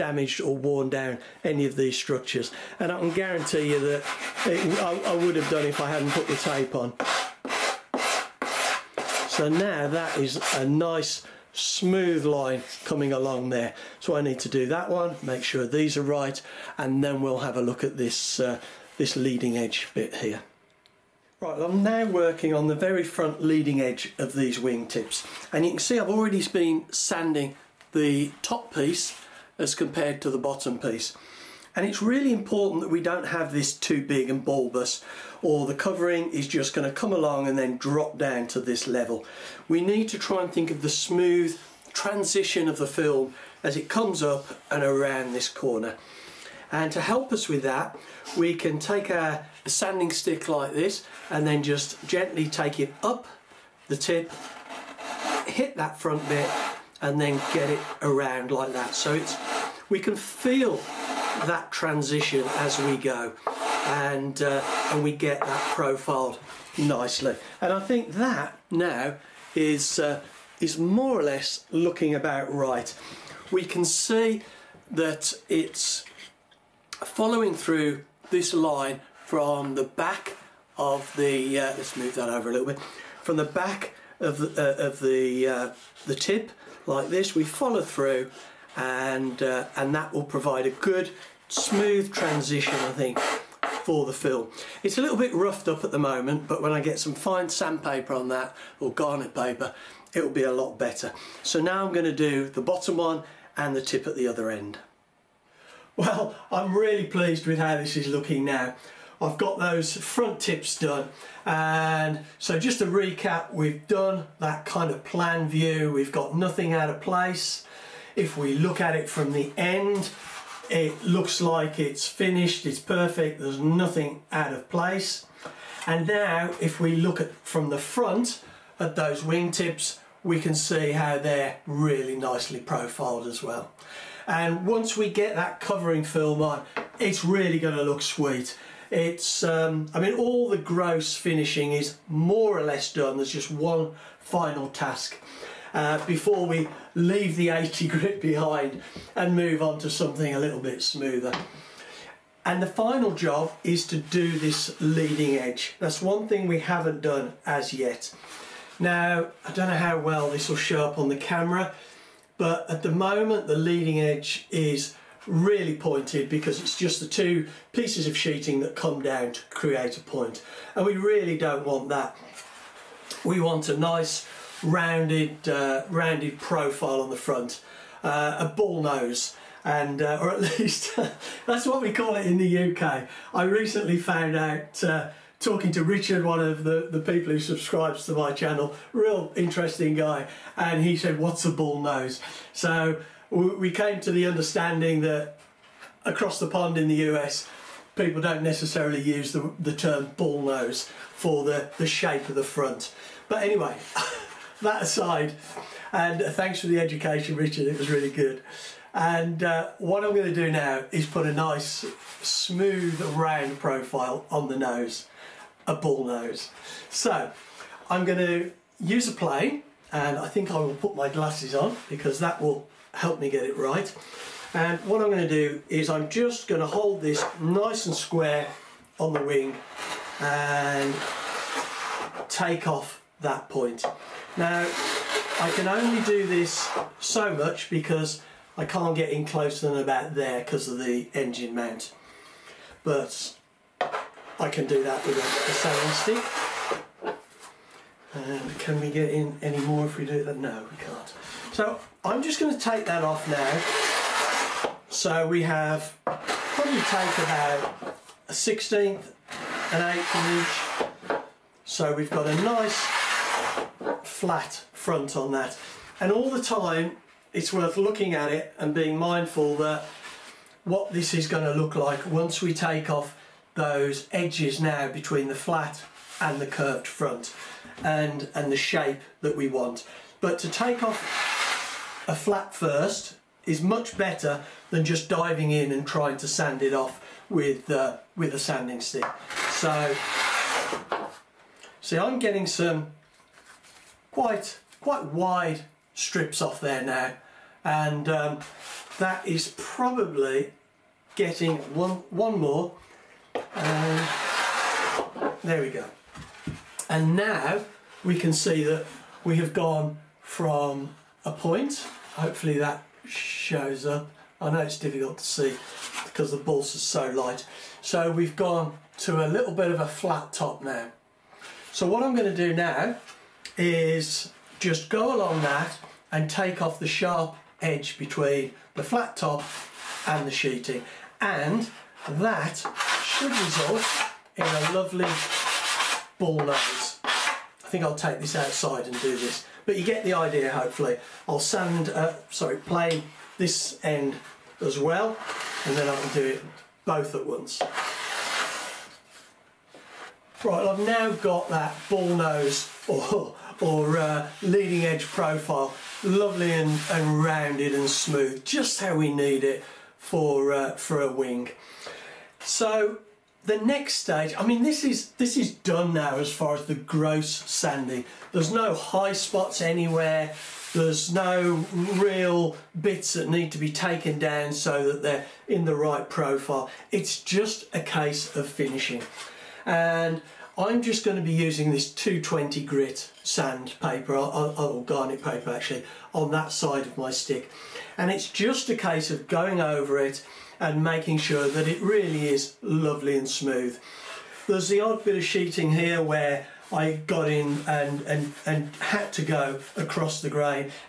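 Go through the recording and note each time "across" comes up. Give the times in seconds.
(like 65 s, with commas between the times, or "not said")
196 s, 399 s.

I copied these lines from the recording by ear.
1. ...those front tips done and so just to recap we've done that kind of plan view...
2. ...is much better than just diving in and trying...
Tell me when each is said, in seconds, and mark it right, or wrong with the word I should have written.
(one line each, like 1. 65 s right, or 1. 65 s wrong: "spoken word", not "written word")
1. 109 s right
2. 283 s right.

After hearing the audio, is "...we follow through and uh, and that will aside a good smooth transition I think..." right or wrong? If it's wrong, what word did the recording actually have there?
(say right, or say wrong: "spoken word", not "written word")
wrong: "provide", not "aside".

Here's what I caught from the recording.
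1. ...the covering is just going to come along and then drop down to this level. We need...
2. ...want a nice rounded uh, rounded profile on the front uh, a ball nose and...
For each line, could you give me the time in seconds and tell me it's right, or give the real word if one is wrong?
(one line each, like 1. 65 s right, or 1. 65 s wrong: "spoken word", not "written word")
1. 35 s right
2. 173 s right.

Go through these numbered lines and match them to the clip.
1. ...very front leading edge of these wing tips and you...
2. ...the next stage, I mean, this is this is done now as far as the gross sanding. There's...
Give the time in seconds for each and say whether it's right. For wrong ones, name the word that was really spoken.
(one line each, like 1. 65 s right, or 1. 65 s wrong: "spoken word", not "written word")
1. 22 s right
2. 363 s right.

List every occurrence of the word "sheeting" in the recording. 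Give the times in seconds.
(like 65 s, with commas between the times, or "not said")
168 s, 330 s, 395 s.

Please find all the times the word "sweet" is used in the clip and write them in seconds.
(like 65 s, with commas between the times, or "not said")
138 s.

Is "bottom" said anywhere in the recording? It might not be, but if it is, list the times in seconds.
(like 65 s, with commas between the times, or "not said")
30 s, 102 s.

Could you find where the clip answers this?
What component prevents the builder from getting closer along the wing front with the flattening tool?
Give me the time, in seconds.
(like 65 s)
240 s.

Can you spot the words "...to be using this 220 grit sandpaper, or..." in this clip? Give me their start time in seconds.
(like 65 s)
381 s.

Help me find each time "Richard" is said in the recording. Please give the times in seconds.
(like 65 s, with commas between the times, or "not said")
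185 s, 207 s.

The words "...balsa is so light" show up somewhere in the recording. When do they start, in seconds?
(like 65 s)
316 s.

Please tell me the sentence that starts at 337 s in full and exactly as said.
I think I'll take this outside and do this.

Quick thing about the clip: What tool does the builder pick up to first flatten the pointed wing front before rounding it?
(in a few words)
A plane.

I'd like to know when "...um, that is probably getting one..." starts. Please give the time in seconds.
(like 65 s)
298 s.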